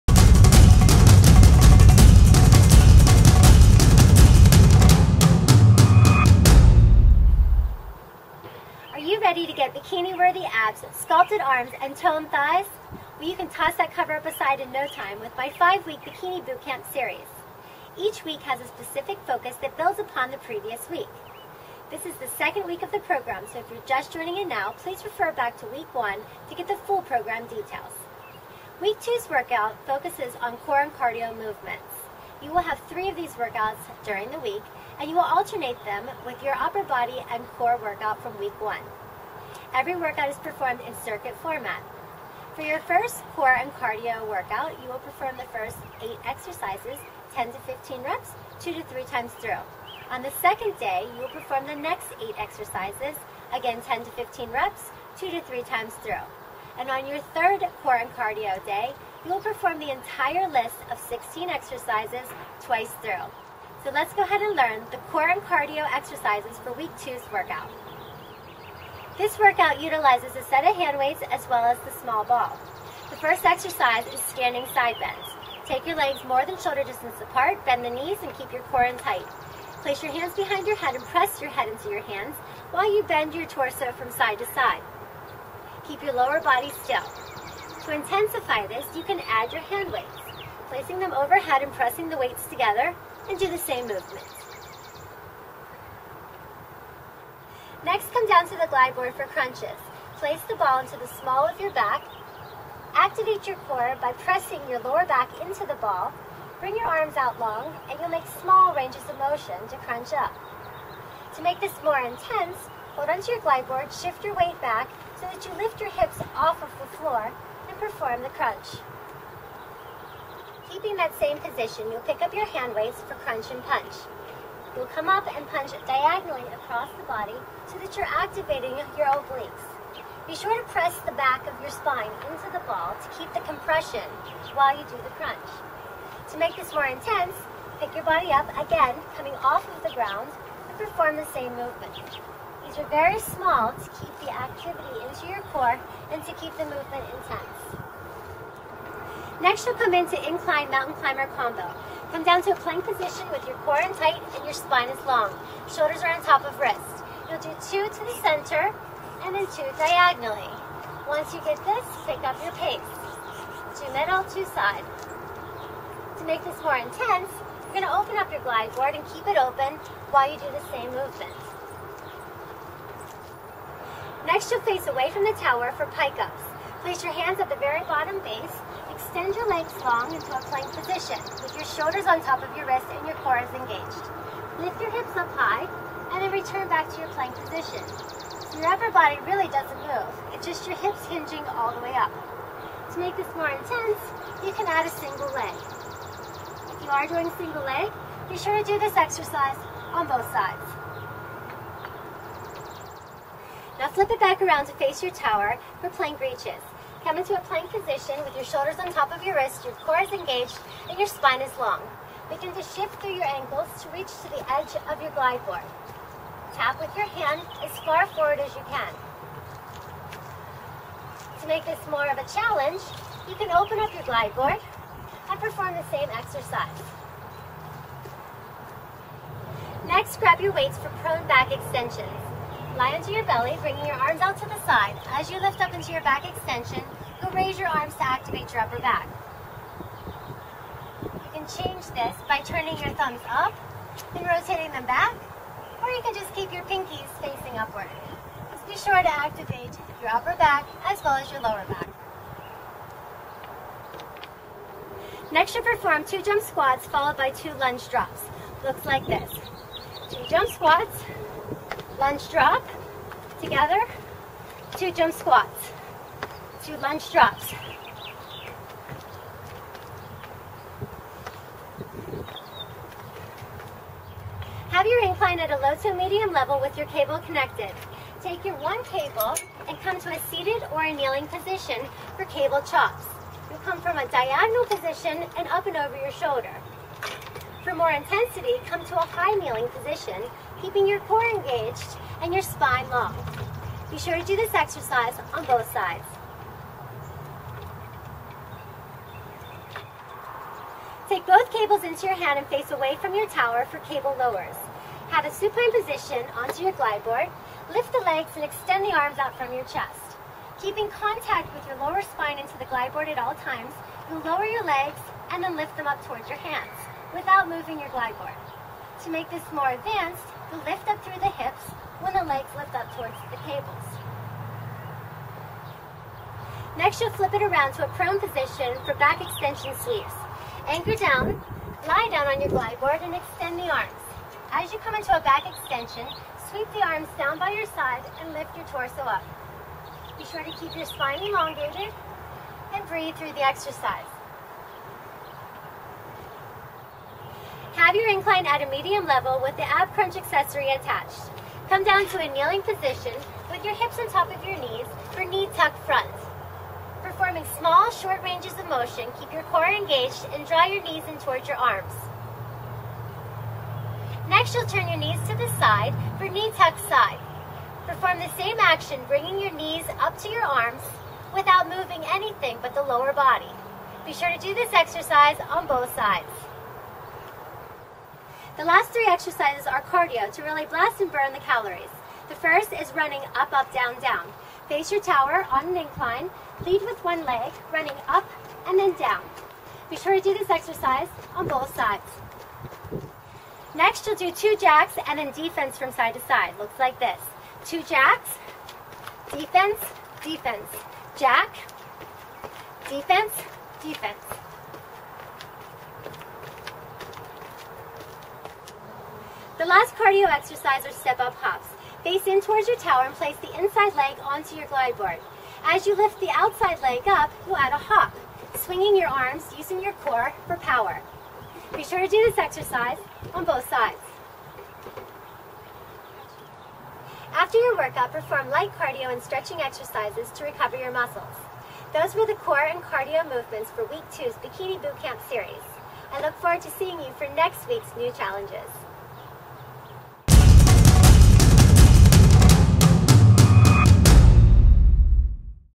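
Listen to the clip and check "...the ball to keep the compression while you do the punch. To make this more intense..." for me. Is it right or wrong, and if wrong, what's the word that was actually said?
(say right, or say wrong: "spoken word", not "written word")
wrong: "crunch", not "punch".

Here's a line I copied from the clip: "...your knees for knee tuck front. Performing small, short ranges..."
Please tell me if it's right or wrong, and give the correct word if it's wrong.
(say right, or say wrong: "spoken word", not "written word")
right.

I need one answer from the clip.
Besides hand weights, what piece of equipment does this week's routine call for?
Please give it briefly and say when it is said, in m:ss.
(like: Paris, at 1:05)
small ball, at 1:12.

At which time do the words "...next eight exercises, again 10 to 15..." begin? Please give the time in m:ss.
0:51.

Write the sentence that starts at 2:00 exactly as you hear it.
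Keeping that same position, you'll pick up your hand weights for crunch and punch.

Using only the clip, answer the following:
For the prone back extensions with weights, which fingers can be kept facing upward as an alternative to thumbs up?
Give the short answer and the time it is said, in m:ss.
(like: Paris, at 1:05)
pinkies, at 4:06.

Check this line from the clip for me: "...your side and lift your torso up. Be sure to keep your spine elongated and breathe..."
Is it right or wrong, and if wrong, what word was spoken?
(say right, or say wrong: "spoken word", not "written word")
right.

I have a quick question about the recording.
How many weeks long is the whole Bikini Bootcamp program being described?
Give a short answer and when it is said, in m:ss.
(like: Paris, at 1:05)
5, at 0:15.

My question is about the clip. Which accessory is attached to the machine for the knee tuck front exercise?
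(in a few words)
ab crunch accessory.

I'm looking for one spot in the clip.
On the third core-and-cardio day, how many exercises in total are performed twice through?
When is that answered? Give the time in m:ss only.
1:00.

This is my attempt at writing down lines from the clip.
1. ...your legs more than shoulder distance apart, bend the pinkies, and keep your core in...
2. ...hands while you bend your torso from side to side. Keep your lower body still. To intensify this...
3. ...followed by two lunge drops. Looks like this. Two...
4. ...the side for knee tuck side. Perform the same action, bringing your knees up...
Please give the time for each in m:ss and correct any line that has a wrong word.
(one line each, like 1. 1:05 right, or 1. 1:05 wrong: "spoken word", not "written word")
1. 1:15 wrong: "knees", not "pinkies"
2. 1:22 right
3. 4:16 right
4. 6:05 right.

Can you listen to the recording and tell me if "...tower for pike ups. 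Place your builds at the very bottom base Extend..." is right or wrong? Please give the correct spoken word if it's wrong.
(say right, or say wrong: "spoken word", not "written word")
wrong: "hands", not "builds".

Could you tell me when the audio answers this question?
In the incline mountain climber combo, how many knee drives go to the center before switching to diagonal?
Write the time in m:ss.
2:37.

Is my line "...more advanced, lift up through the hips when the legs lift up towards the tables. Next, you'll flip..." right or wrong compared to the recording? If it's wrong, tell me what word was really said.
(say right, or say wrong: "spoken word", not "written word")
right.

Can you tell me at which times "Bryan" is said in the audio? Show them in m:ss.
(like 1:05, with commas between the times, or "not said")
not said.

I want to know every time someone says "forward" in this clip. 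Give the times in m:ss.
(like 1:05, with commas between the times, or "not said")
3:38, 7:16.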